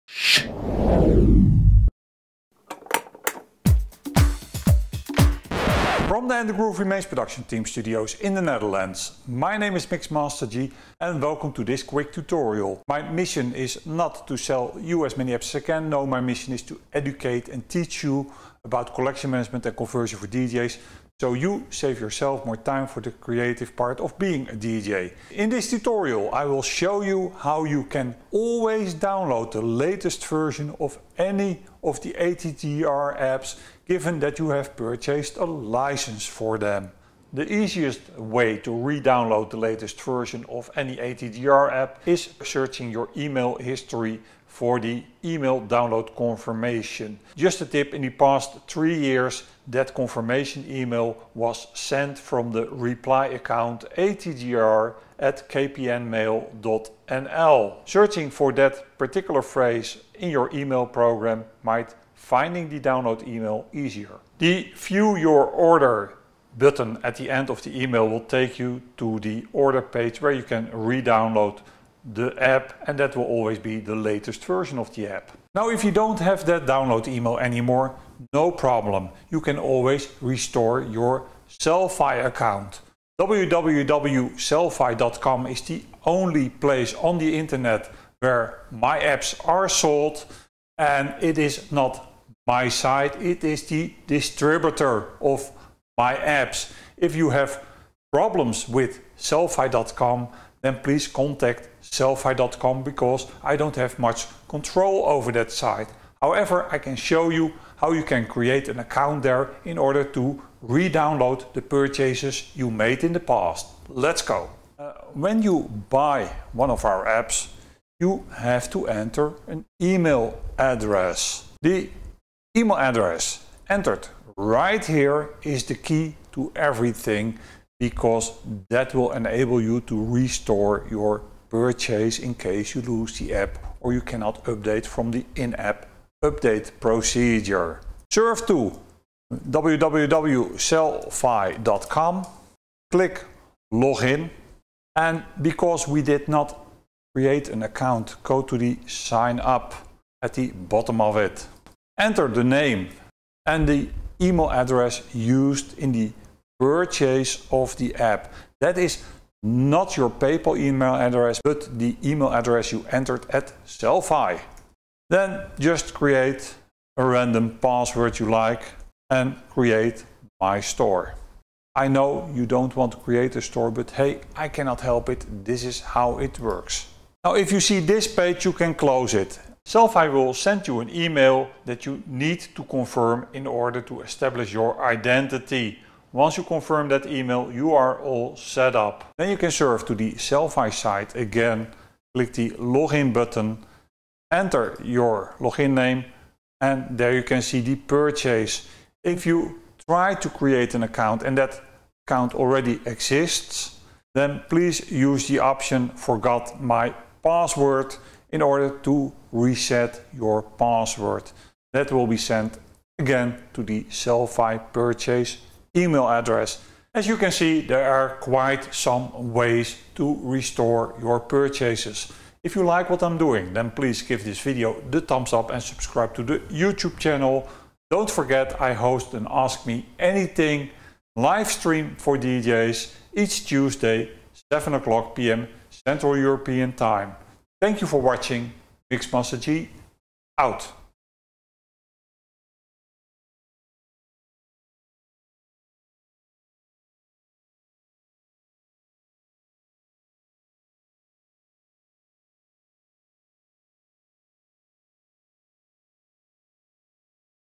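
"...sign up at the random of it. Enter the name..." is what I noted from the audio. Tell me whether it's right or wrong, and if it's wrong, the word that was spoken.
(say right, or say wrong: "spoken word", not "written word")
wrong: "bottom", not "random".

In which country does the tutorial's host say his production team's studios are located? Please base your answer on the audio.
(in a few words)
Netherlands.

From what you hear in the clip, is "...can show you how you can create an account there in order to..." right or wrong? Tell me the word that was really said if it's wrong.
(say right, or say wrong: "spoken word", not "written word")
right.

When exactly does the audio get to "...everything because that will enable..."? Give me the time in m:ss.
2:06.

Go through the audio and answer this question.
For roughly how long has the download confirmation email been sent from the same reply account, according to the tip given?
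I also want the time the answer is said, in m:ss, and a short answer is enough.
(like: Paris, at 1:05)
3 years, at 0:48.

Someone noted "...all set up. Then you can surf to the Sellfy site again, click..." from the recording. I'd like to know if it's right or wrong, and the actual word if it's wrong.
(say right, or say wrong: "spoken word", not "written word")
right.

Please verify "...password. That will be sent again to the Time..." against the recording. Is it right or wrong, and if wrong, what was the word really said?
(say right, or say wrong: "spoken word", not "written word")
wrong: "Sellfy", not "Time".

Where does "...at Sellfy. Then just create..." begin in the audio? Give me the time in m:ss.
2:43.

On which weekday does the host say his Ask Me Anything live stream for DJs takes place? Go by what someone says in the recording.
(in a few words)
Tuesday.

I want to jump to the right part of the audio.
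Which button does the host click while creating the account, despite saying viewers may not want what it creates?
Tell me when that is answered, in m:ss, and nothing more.
2:49.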